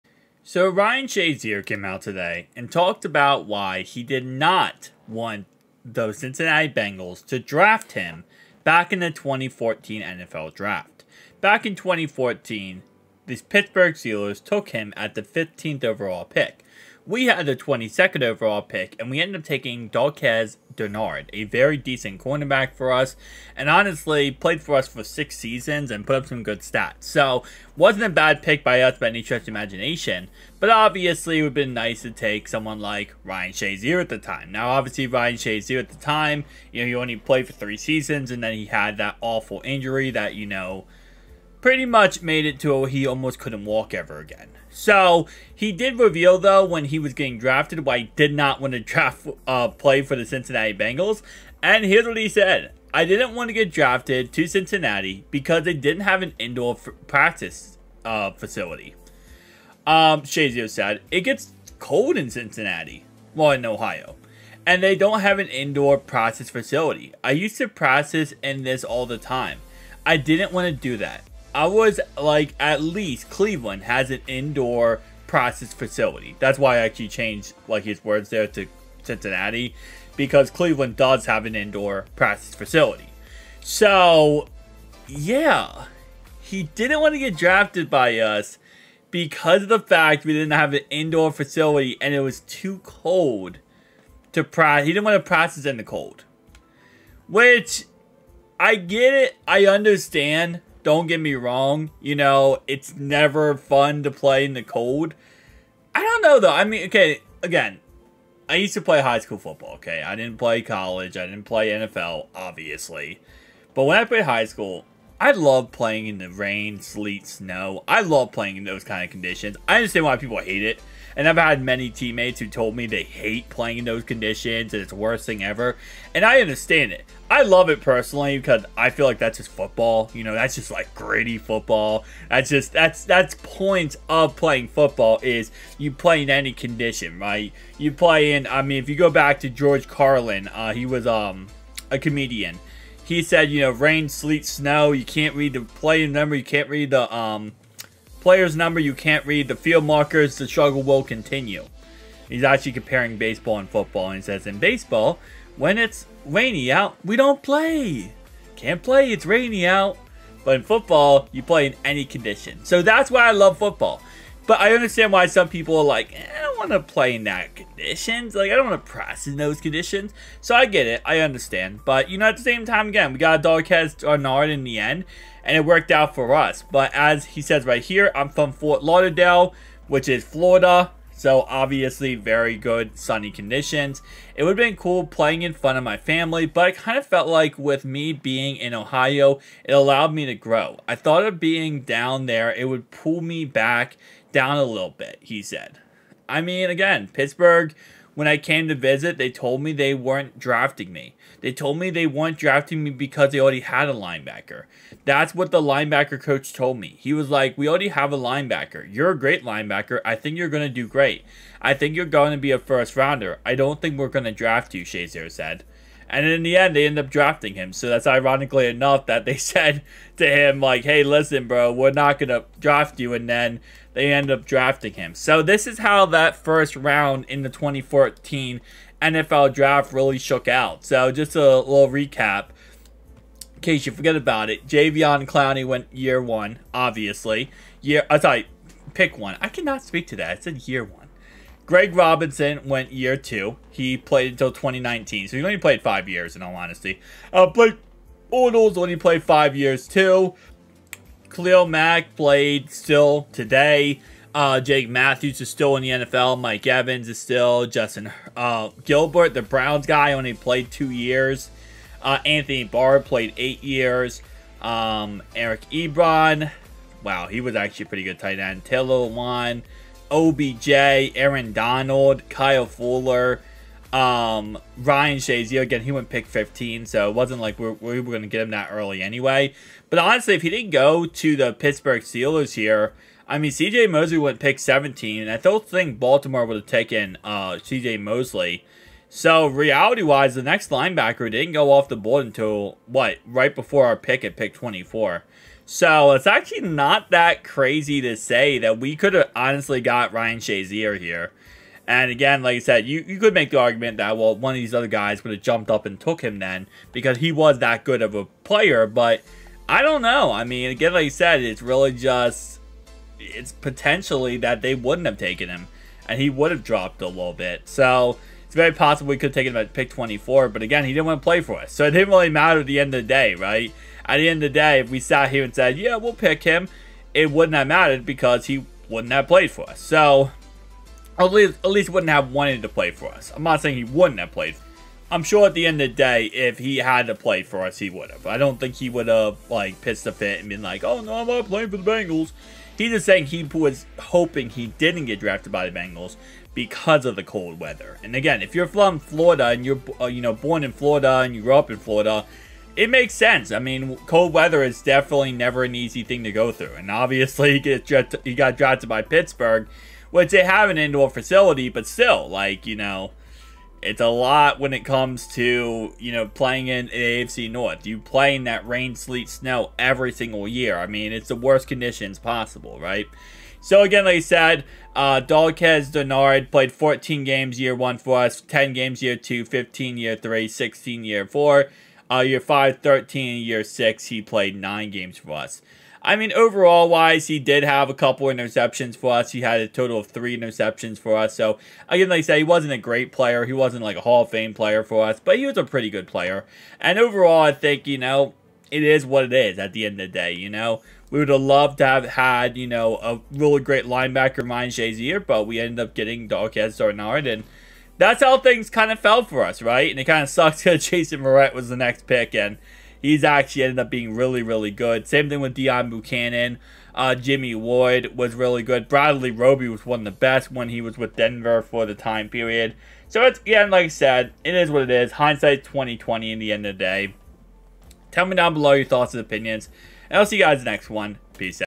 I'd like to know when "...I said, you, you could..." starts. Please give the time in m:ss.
5:02.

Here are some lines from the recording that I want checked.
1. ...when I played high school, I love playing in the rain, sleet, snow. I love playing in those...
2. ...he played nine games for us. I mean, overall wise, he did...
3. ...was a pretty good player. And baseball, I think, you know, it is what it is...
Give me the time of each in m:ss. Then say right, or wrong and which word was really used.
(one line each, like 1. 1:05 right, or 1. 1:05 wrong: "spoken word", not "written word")
1. 1:53 right
2. 6:24 right
3. 6:35 wrong: "overall", not "baseball".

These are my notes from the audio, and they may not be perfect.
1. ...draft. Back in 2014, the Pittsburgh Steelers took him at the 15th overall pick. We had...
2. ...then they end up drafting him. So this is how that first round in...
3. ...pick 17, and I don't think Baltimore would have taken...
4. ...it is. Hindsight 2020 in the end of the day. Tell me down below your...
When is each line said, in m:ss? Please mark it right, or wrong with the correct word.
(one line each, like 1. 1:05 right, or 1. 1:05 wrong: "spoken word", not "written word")
1. 0:10 right
2. 3:43 right
3. 4:44 right
4. 7:04 right.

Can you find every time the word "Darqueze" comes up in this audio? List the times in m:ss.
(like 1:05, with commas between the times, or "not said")
0:19, 6:15, 6:46.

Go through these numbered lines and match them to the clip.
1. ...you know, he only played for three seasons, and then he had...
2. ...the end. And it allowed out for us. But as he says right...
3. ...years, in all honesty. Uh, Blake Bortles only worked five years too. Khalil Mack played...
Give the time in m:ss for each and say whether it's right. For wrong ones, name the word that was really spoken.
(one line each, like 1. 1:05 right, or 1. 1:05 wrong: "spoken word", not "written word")
1. 0:36 right
2. 2:54 wrong: "worked", not "allowed"
3. 4:06 wrong: "played", not "worked".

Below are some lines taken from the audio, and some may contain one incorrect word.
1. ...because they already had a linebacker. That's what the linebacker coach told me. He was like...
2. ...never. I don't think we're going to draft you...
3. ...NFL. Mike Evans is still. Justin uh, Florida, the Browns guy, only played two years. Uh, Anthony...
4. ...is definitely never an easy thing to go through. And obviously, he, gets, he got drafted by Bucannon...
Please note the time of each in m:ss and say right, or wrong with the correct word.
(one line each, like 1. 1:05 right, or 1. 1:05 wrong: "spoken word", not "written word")
1. 3:22 right
2. 3:32 wrong: "rounder", not "never"
3. 4:15 wrong: "Gilbert", not "Florida"
4. 5:54 wrong: "Pittsburgh", not "Bucannon".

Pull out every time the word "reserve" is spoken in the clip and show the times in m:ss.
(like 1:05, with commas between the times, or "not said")
not said.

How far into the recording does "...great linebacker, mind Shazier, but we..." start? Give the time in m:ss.
6:43.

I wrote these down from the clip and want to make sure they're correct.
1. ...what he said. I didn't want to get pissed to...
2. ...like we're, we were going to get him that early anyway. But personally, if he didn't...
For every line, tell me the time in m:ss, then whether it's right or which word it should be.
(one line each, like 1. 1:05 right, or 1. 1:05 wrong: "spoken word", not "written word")
1. 0:52 wrong: "drafted", not "pissed"
2. 4:37 wrong: "honestly", not "personally".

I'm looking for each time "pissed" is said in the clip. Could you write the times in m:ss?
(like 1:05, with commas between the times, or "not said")
5:39.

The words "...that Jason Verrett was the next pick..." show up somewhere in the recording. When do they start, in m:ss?
6:50.